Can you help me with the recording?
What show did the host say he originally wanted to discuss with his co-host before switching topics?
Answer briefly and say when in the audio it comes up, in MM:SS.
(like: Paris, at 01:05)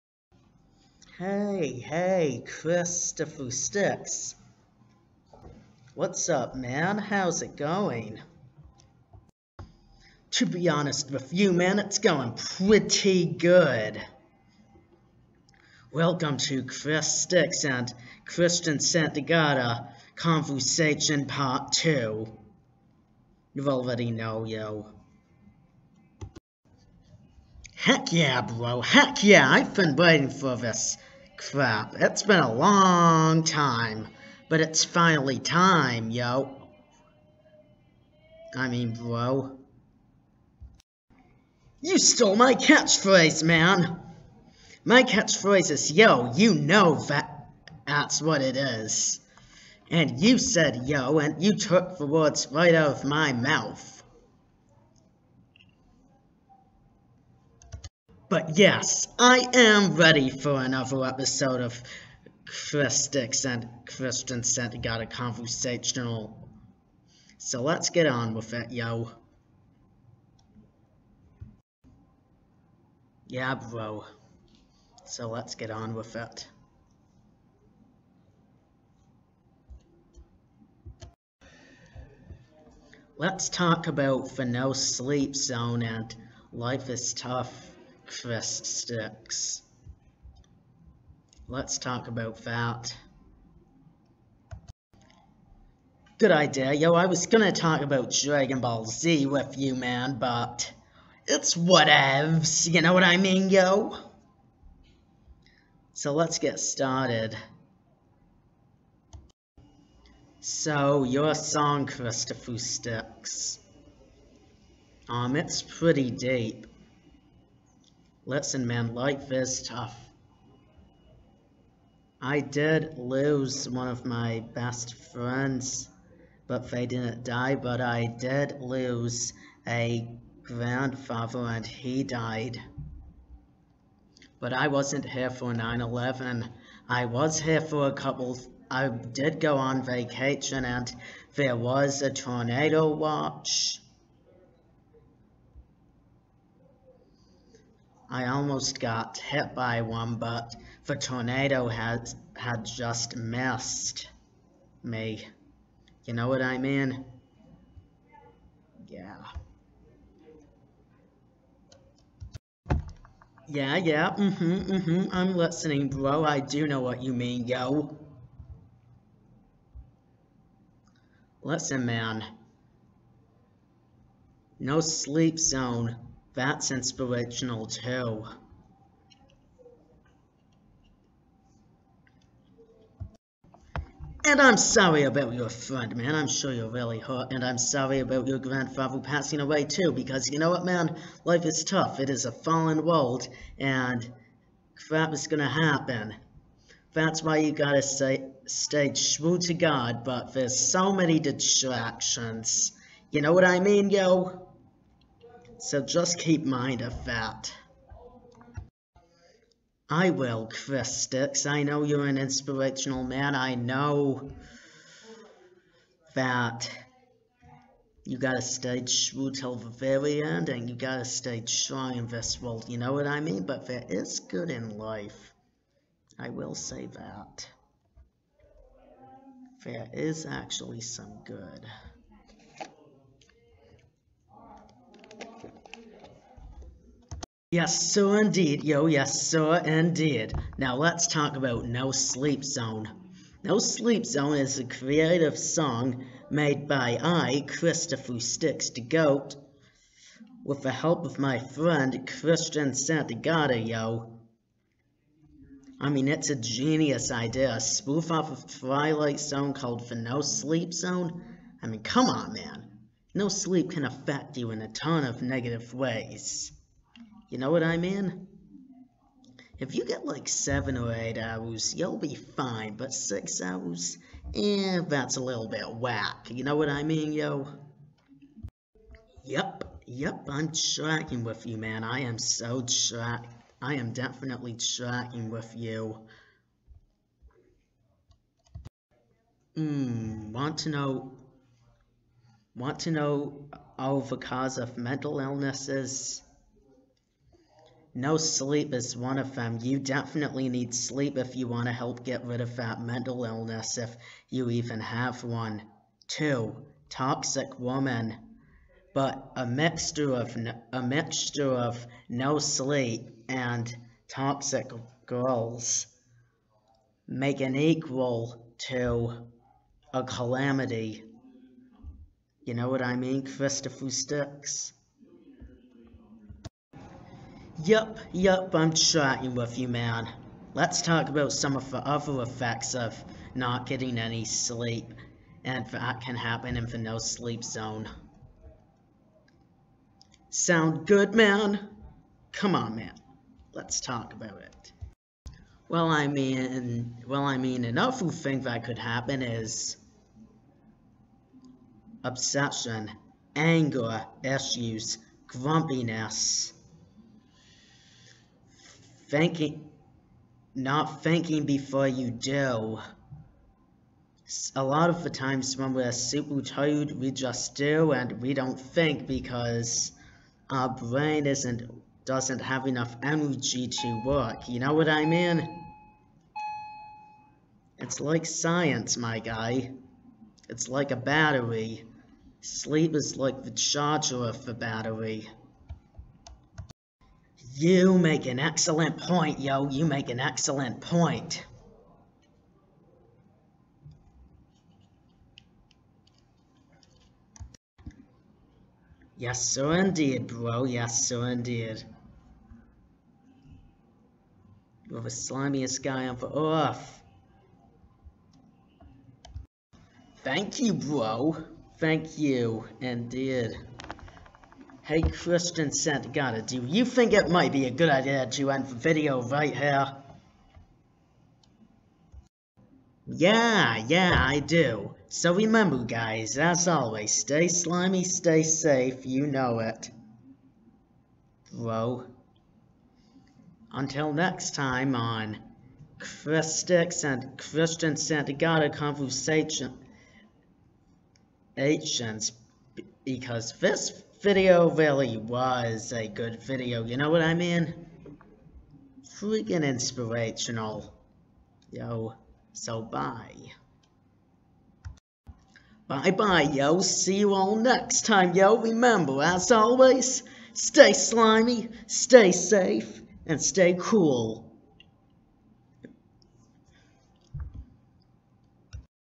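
Dragon Ball Z, at 01:38.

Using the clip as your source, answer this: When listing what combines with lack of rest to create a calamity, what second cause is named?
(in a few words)
toxic woman.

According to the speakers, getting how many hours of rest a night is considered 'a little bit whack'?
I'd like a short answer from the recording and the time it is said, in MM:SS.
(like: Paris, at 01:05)
6, at 04:32.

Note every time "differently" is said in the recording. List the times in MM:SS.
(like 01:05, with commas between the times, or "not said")
not said.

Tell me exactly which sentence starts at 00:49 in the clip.
And you said yo, and you took the words right out of my mouth.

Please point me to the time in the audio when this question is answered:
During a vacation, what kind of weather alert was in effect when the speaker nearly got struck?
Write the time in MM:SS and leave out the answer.
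02:22.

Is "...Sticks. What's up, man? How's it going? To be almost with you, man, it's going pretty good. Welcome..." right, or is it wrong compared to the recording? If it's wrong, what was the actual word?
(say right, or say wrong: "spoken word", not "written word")
wrong: "honest", not "almost".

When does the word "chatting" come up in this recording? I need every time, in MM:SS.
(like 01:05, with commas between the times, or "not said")
05:28.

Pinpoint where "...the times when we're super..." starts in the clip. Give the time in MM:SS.
06:05.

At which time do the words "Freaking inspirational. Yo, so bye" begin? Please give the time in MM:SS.
07:29.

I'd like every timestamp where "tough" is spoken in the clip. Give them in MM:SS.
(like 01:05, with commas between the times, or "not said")
01:27, 01:59, 03:11.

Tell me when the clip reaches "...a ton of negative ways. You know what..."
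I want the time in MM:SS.
04:24.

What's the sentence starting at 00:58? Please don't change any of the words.
But yes, I am ready for another episode of Chris Sticks and Christian Santagata Conversational.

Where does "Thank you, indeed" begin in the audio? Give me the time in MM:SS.
06:51.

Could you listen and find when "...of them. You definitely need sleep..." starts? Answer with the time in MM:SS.
04:59.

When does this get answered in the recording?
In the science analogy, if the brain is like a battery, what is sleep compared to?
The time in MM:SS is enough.
06:23.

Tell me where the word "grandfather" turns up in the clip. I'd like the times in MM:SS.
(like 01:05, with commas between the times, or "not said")
02:10, 03:08.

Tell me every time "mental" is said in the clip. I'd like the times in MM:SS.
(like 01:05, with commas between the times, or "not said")
04:54, 05:02.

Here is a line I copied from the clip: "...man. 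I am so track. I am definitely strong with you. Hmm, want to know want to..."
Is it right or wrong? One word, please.
wrong.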